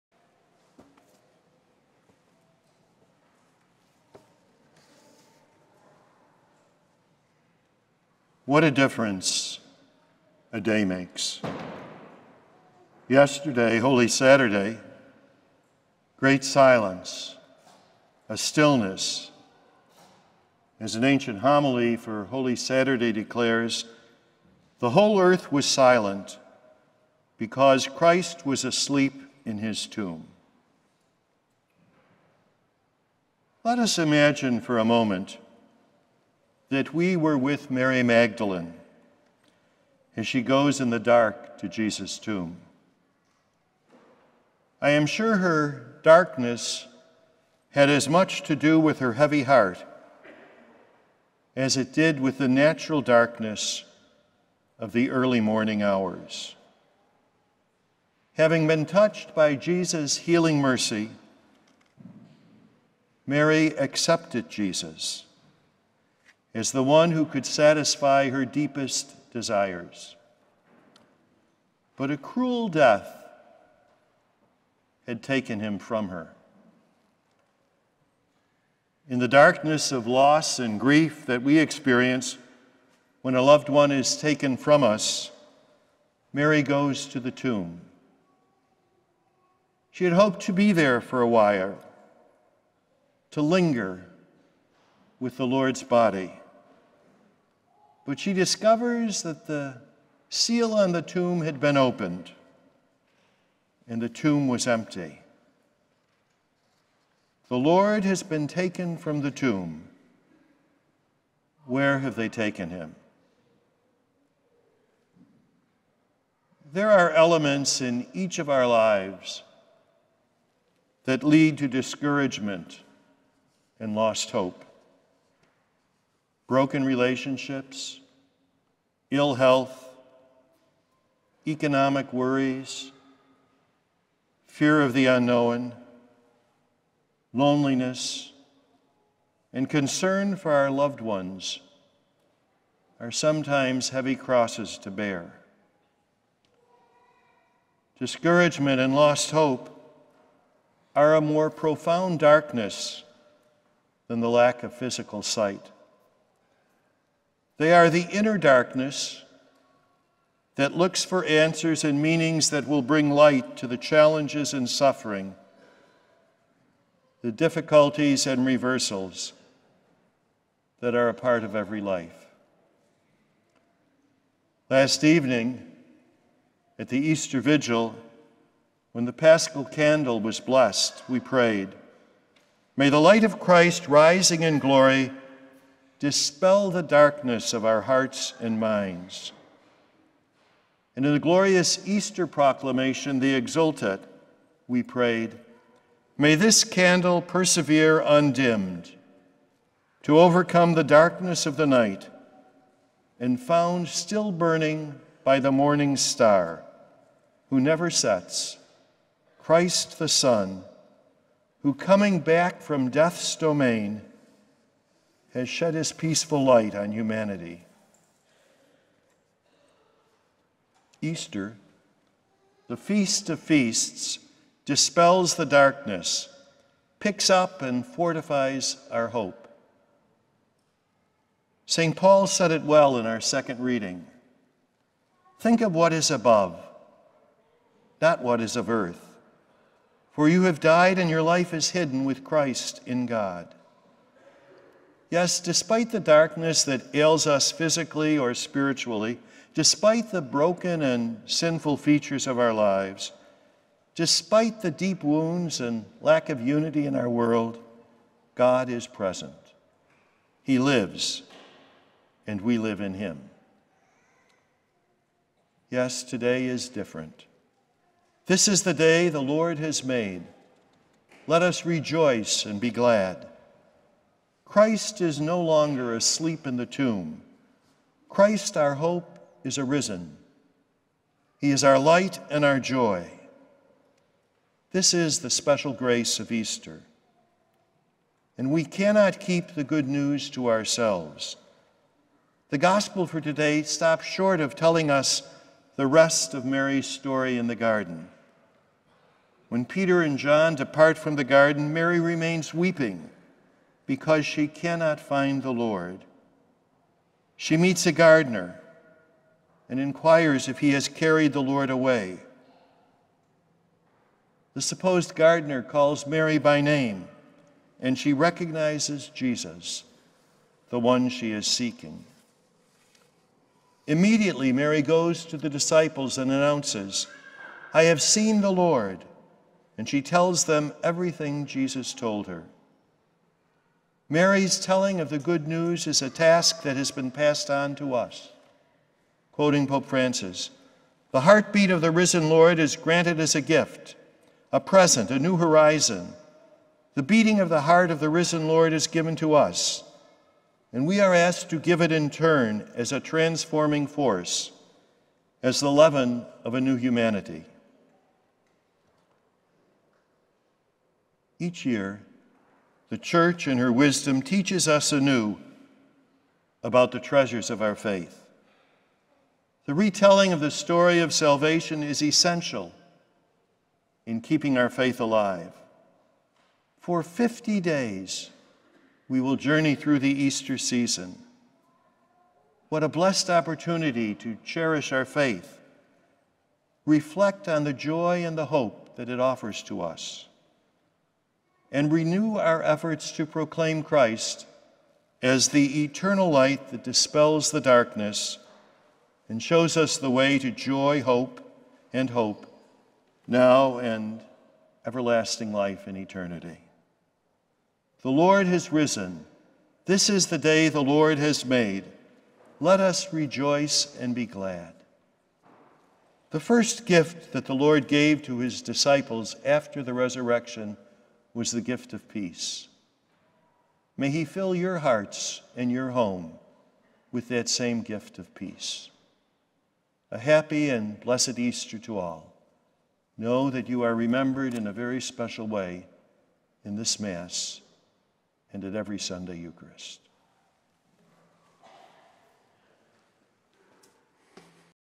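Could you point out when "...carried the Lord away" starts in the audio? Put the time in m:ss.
5:10.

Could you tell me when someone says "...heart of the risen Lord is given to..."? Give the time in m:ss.
5:47.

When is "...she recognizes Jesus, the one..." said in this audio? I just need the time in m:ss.
5:17.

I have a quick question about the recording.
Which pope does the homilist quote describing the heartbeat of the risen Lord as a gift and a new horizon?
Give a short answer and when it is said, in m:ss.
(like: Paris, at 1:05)
Pope Francis, at 5:39.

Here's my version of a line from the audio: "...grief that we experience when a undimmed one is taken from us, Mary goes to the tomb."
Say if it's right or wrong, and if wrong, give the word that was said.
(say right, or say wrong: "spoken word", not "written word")
wrong: "loved", not "undimmed".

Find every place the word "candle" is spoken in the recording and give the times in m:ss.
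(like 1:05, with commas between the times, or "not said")
2:59, 3:16.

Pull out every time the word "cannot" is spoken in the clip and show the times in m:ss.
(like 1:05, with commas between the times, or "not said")
4:48, 5:04.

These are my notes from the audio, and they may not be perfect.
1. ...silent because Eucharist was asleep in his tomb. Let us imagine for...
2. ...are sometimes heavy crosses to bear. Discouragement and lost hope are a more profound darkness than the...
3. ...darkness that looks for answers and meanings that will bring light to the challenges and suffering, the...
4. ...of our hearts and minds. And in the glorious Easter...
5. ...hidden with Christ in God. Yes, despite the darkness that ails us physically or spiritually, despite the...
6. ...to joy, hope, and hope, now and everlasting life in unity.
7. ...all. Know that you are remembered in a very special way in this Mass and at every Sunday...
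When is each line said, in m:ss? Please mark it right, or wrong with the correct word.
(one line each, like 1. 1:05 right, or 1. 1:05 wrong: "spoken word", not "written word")
1. 0:25 wrong: "Christ", not "Eucharist"
2. 2:22 right
3. 2:38 right
4. 3:07 right
5. 4:01 right
6. 6:40 wrong: "eternity", not "unity"
7. 7:11 right.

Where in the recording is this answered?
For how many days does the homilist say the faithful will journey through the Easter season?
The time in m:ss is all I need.
6:17.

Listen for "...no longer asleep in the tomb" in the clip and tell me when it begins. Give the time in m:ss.
4:35.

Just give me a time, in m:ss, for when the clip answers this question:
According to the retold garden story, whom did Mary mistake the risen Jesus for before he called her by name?
5:07.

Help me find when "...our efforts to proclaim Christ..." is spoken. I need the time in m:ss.
6:32.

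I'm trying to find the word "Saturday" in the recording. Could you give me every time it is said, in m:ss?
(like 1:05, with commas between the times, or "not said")
0:14, 0:22.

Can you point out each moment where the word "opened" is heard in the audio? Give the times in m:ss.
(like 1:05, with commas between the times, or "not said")
1:41.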